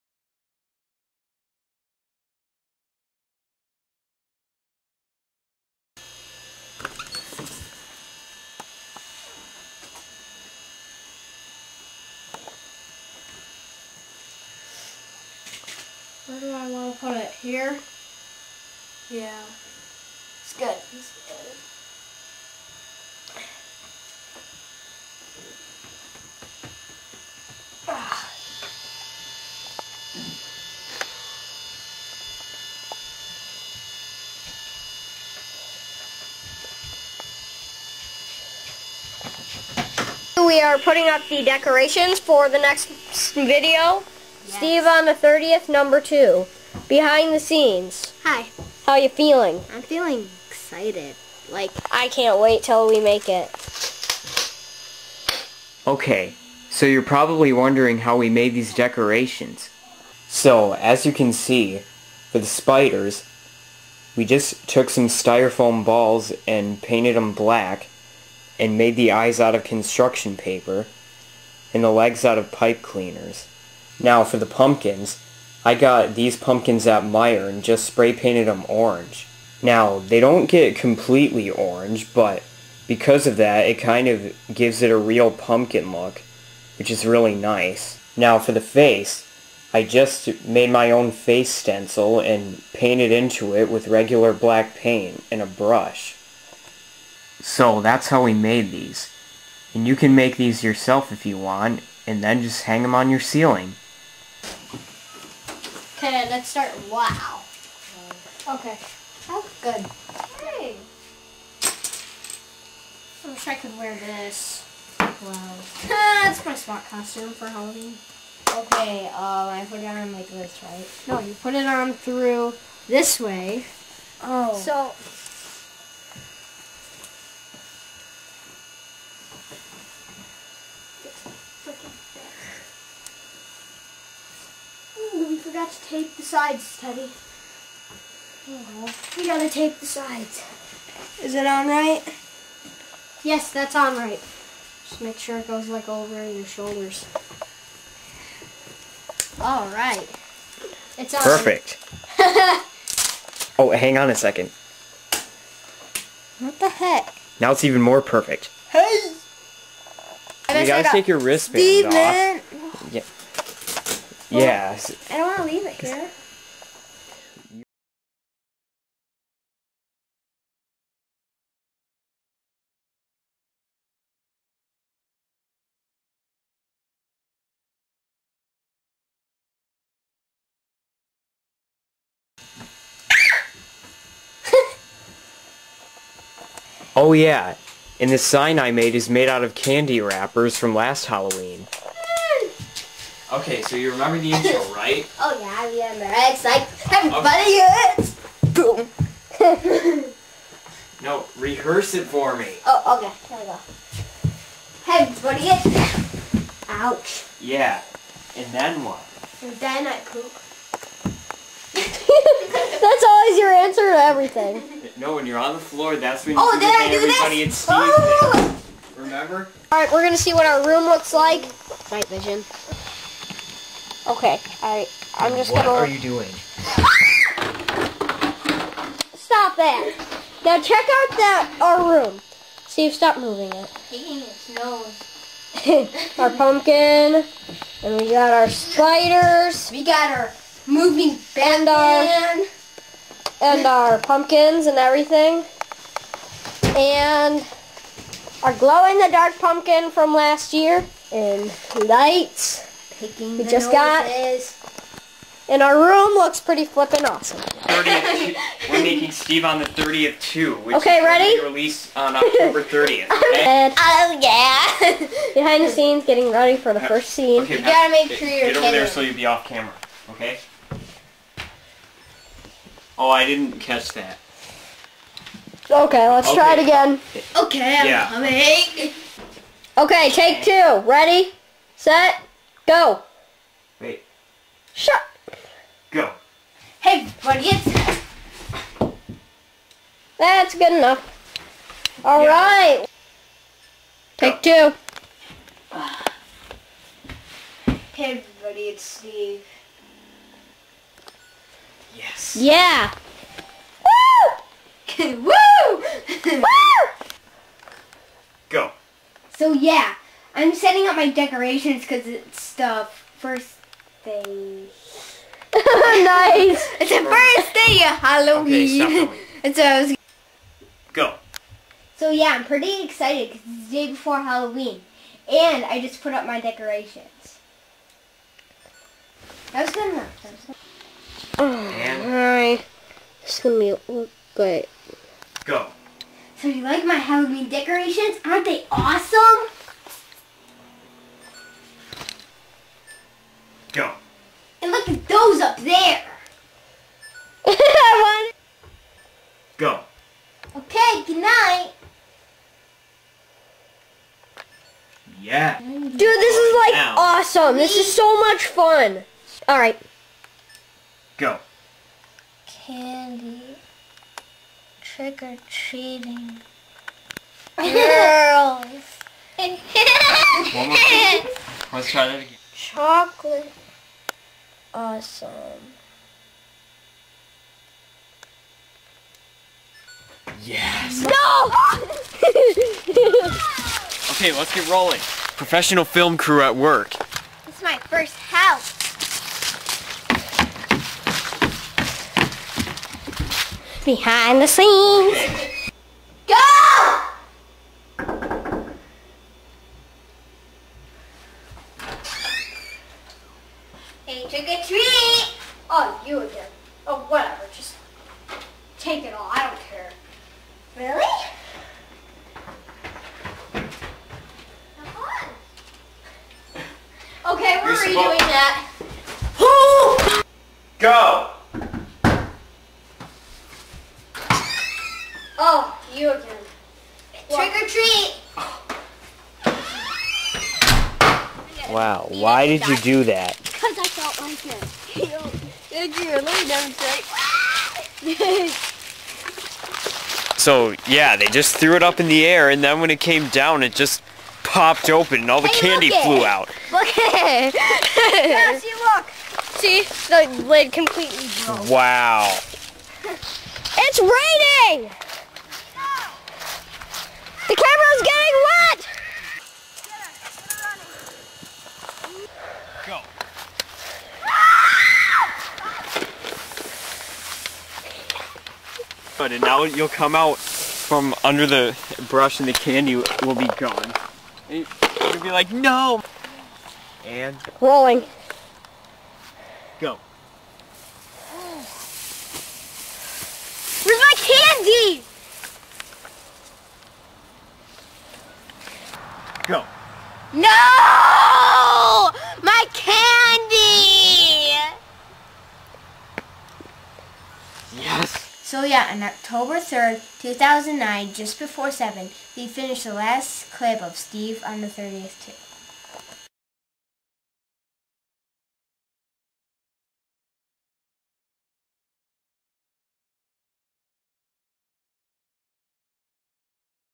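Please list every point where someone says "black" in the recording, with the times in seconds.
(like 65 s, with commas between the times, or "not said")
67 s, 94 s.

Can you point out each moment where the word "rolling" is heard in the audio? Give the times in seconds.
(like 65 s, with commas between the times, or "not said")
384 s, 477 s.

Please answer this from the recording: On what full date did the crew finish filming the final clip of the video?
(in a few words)
October 3rd, 2009.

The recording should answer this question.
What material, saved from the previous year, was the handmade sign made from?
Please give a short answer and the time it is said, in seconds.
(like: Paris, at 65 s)
Candy wrappers, at 189 s.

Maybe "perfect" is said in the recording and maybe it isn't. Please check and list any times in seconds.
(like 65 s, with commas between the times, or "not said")
151 s, 158 s.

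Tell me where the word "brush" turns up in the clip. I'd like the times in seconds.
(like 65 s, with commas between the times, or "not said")
95 s, 472 s.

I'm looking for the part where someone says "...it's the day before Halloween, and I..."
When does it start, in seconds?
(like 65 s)
323 s.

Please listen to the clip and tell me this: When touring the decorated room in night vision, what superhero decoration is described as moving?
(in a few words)
Batman.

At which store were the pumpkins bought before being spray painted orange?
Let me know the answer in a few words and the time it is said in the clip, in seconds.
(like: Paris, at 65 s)
Meijer, at 77 s.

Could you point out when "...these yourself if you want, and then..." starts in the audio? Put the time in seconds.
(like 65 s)
100 s.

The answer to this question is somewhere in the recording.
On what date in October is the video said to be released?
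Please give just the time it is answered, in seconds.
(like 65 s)
262 s.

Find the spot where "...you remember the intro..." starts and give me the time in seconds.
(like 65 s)
193 s.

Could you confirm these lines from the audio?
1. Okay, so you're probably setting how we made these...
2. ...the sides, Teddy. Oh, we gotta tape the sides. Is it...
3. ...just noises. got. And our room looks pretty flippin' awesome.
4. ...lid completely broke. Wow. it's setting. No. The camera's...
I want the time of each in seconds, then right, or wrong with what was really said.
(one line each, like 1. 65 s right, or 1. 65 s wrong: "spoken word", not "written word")
1. 55 s wrong: "wondering", not "setting"
2. 136 s right
3. 253 s right
4. 450 s wrong: "raining", not "setting".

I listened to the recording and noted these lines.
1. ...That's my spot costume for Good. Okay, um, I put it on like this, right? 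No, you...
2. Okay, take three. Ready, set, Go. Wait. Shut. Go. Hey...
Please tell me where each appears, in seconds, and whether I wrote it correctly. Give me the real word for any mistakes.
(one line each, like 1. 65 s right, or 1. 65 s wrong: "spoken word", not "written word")
1. 115 s wrong: "Halloween", not "Good"
2. 279 s wrong: "two", not "three".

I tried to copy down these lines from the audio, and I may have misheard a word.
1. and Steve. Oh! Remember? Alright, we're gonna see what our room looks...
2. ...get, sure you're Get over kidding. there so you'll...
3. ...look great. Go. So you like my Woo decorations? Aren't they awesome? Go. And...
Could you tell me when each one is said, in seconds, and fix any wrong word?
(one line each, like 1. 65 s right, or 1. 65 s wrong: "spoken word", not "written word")
1. 217 s right
2. 268 s right
3. 333 s wrong: "Halloween", not "Woo".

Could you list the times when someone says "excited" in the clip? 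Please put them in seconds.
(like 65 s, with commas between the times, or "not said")
50 s, 322 s.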